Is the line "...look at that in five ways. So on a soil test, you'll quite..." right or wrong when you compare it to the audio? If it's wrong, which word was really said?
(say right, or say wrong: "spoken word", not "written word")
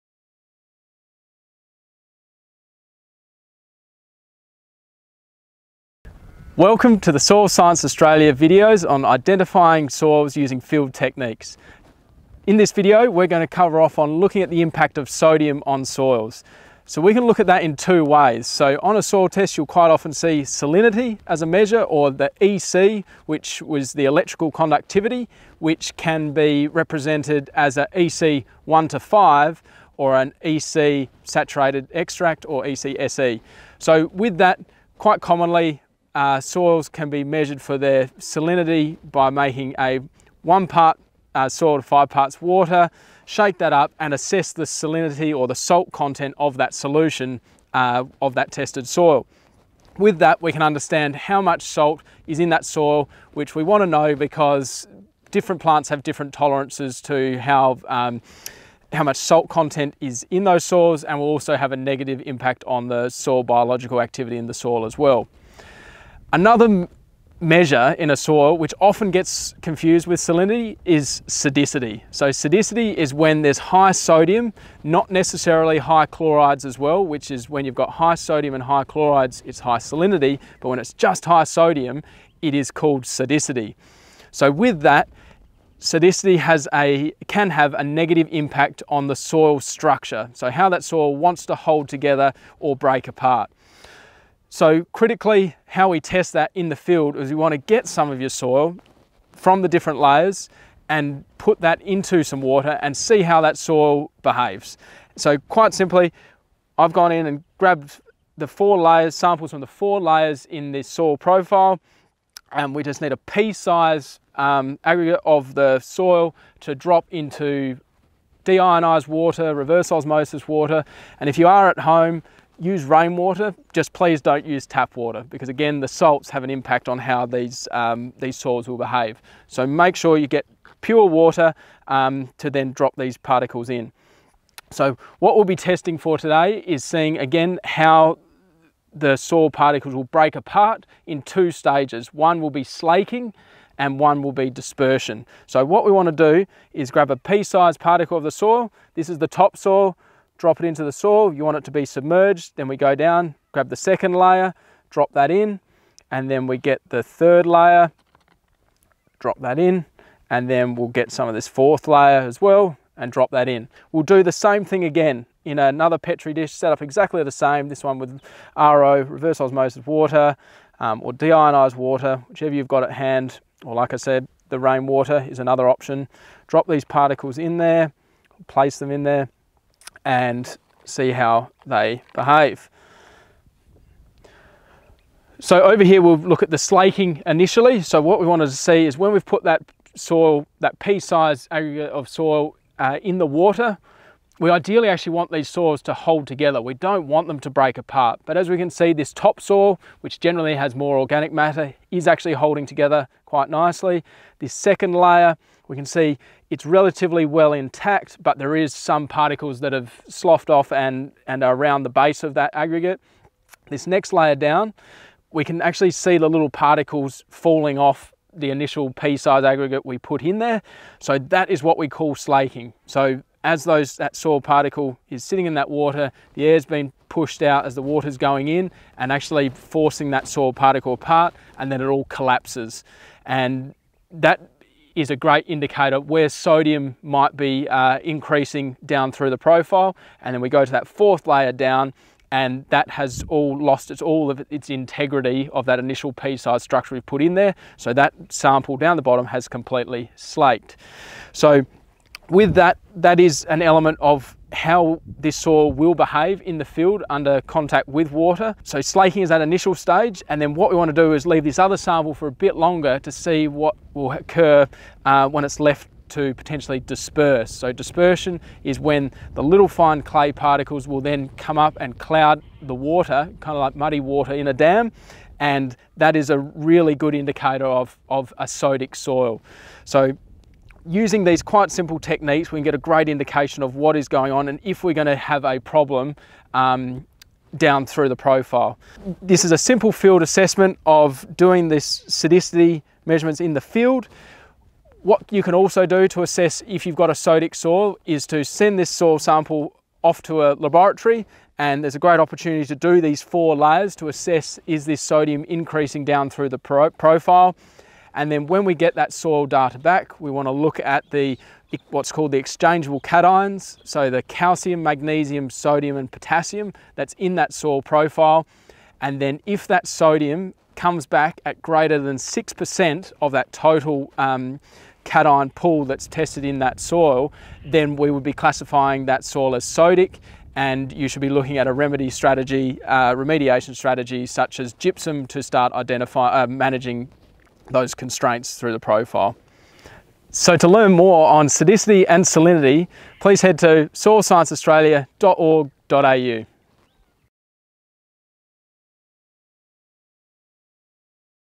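wrong: "two", not "five".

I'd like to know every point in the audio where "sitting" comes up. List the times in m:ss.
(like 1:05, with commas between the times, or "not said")
3:45.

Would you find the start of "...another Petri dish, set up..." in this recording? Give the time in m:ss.
2:45.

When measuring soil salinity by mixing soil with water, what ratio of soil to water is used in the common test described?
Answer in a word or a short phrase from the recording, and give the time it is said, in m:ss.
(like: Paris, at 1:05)
1 to 5, at 0:40.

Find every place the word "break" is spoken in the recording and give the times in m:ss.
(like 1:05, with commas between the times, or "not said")
1:32, 2:20, 3:17.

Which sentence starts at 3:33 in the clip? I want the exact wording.
This next layer down, we can actually see the little particles falling off the initial pea size aggregate we put in there.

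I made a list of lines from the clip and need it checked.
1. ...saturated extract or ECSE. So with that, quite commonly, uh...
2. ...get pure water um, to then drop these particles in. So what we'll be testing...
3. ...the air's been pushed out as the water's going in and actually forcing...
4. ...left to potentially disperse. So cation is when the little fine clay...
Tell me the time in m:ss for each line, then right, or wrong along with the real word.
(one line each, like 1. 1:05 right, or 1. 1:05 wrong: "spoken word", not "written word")
1. 0:31 right
2. 2:10 right
3. 3:46 right
4. 4:25 wrong: "dispersion", not "cation".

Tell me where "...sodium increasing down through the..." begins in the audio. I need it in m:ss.
5:05.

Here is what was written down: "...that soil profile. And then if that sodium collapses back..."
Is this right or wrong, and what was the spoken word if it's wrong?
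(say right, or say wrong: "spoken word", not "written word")
wrong: "comes", not "collapses".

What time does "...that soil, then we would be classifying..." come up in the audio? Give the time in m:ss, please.
5:26.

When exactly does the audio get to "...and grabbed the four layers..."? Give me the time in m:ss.
1:47.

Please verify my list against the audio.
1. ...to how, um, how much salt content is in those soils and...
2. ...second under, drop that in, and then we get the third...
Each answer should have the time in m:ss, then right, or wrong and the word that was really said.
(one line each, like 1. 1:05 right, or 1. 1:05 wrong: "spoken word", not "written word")
1. 0:57 right
2. 2:33 wrong: "layer", not "under".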